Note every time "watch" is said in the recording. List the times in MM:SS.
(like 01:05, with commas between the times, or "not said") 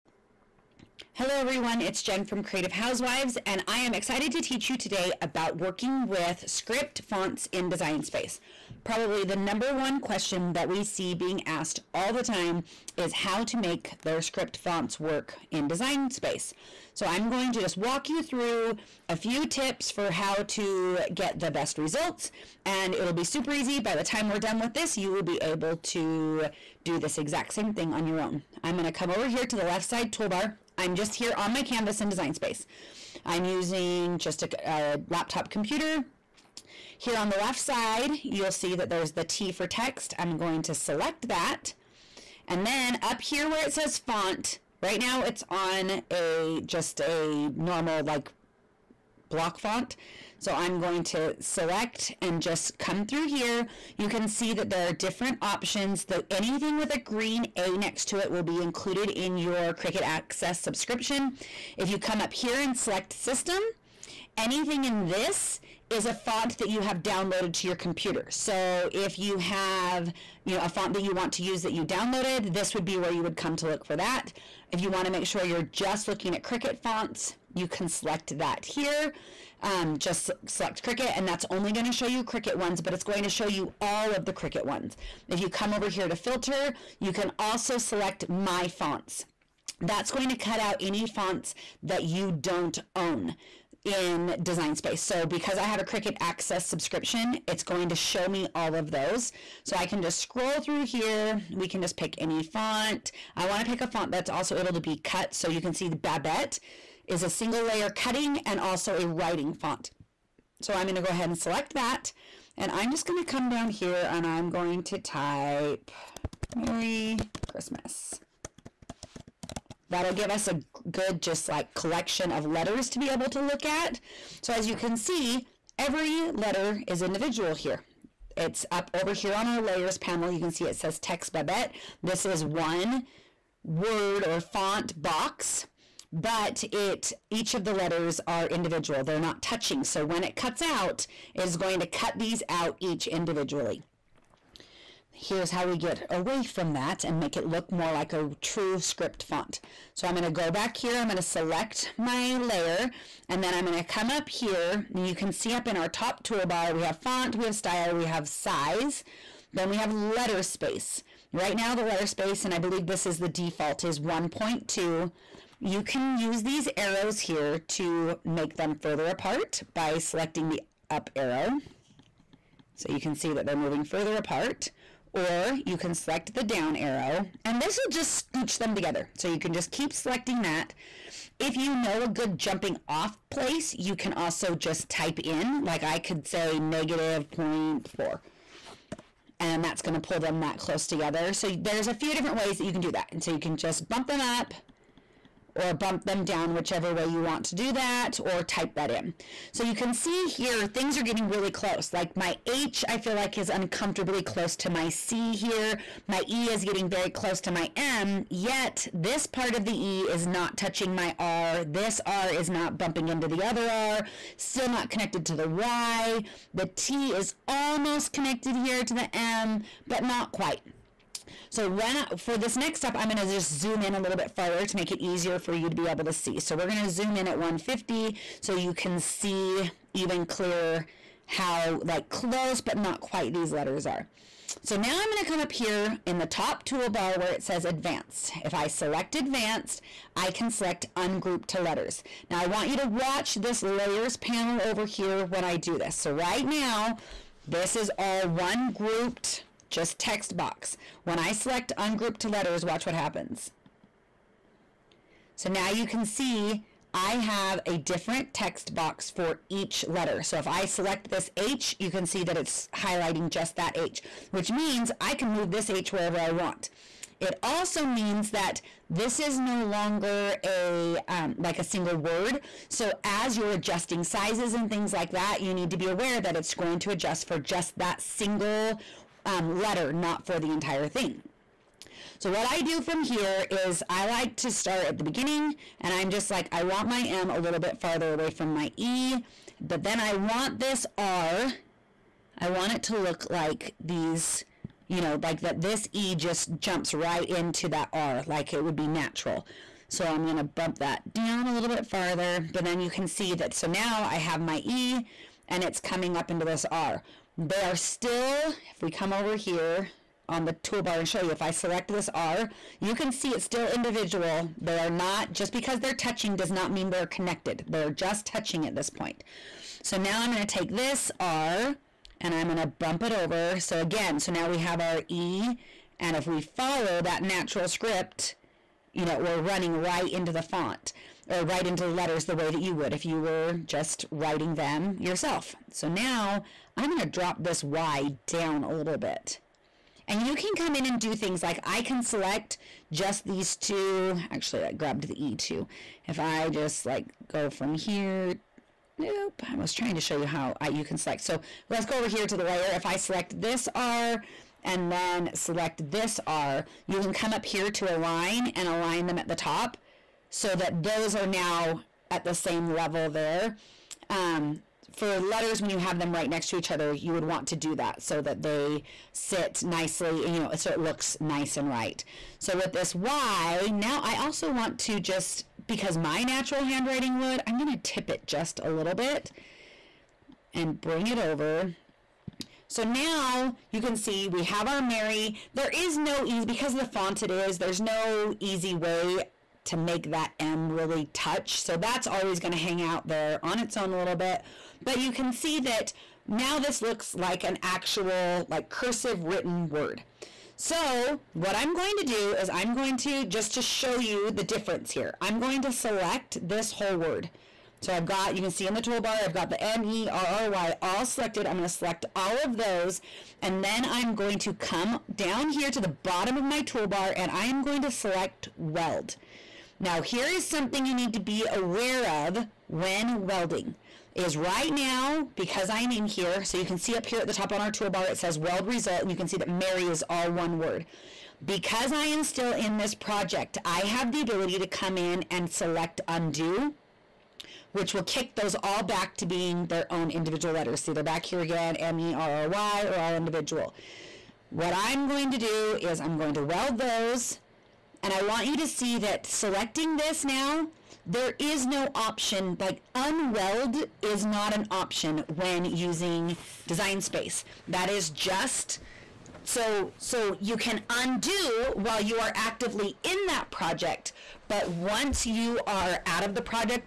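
04:02, 04:12.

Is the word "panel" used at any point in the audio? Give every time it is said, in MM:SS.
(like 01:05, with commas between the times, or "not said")
02:09, 04:04.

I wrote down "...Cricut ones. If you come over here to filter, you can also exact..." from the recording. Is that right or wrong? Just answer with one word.
wrong.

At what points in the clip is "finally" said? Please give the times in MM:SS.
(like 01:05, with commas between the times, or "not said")
not said.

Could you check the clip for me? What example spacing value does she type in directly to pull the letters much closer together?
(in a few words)
-0.4.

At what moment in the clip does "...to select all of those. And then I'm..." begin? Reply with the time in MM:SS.
06:51.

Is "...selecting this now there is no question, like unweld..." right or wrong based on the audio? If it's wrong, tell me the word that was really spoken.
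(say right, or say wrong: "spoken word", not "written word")
wrong: "option", not "question".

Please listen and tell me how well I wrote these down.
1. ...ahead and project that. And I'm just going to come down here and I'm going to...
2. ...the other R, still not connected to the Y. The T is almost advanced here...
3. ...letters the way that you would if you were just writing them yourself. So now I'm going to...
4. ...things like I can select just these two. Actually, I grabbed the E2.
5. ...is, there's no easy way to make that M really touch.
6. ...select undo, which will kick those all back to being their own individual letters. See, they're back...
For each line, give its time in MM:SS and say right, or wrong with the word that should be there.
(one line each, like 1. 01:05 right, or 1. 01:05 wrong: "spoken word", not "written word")
1. 01:51 wrong: "select", not "project"
2. 03:33 wrong: "connected", not "advanced"
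3. 05:31 right
4. 05:41 right
5. 06:27 right
6. 07:15 right.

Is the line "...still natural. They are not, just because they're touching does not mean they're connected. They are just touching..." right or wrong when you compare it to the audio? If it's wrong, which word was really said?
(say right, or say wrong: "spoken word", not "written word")
wrong: "individual", not "natural".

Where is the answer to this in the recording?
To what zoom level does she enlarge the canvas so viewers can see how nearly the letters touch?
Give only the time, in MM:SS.
03:47.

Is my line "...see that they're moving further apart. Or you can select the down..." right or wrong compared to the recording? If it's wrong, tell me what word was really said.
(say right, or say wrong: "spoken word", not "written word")
right.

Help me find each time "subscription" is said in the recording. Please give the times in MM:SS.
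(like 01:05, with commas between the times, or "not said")
01:00, 01:36.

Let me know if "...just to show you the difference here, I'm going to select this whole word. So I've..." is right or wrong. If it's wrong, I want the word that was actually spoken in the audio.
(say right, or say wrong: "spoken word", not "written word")
right.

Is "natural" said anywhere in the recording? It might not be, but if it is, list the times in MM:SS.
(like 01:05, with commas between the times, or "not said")
04:58, 05:27, 06:16.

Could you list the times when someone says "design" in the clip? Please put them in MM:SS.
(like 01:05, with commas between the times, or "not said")
00:07, 00:15, 00:32, 01:34, 07:36.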